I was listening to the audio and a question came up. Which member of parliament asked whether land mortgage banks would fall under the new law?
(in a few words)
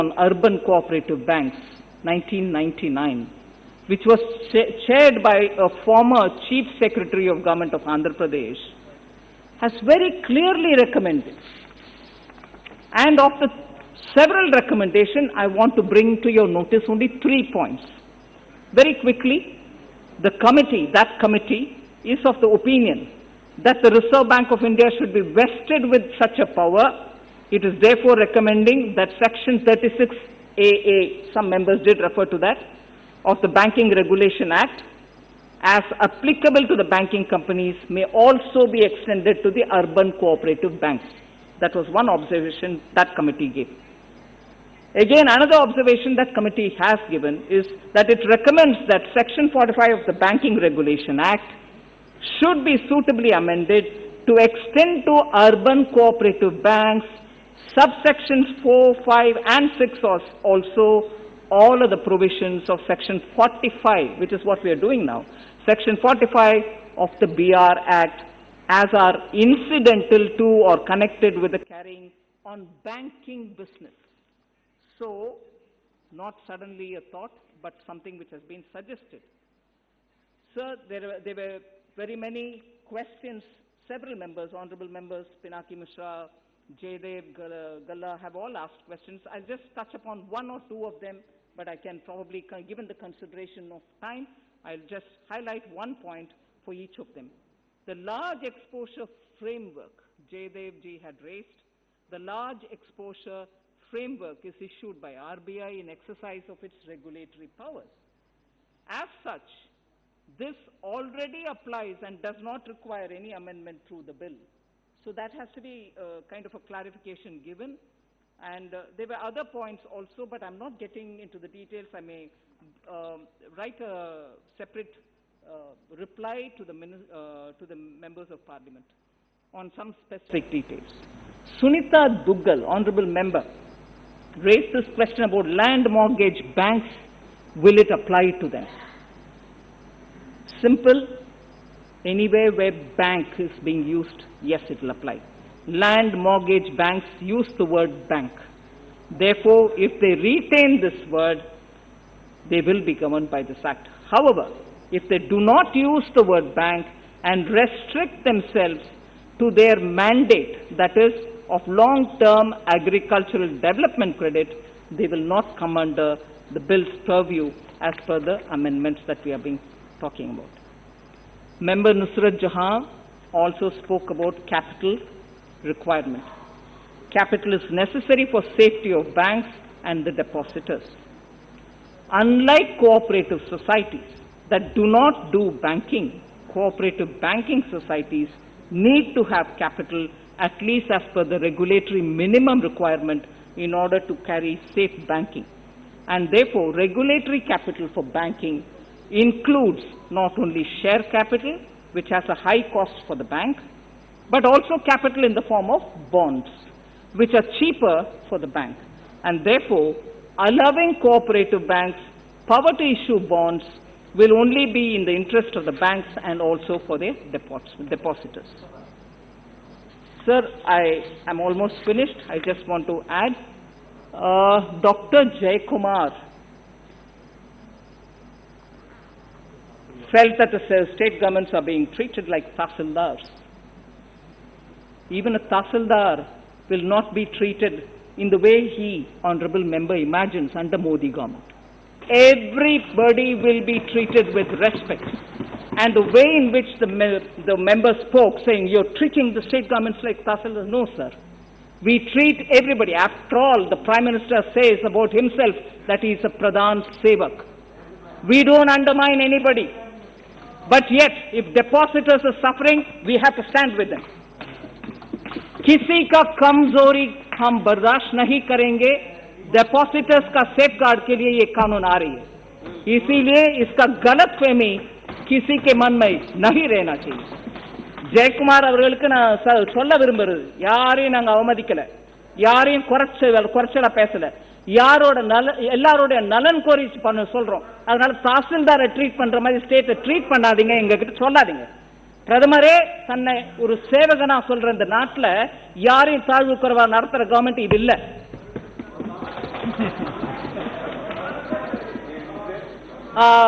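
Sunita Duggal.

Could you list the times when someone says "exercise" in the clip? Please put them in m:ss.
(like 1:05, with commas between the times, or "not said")
1:45.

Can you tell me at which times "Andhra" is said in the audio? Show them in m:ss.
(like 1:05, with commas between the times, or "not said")
0:07.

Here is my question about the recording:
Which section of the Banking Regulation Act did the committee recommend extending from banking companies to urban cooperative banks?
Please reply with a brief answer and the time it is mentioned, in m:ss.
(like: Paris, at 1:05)
Section 36AA, at 0:29.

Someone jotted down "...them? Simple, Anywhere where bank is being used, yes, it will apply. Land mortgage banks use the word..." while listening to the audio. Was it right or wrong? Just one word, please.
right.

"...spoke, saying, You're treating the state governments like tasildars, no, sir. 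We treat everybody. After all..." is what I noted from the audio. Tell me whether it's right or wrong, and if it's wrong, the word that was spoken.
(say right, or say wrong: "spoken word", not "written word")
right.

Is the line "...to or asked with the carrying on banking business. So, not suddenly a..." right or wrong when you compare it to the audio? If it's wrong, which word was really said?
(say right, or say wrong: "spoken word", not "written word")
wrong: "connected", not "asked".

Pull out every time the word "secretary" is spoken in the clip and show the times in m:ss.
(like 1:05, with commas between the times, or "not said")
0:06.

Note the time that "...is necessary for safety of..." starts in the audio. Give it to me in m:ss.
2:57.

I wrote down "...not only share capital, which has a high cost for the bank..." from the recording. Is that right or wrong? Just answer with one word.
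right.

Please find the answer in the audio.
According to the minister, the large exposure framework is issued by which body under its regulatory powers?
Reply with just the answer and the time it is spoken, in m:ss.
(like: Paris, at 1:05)
RBI, at 1:45.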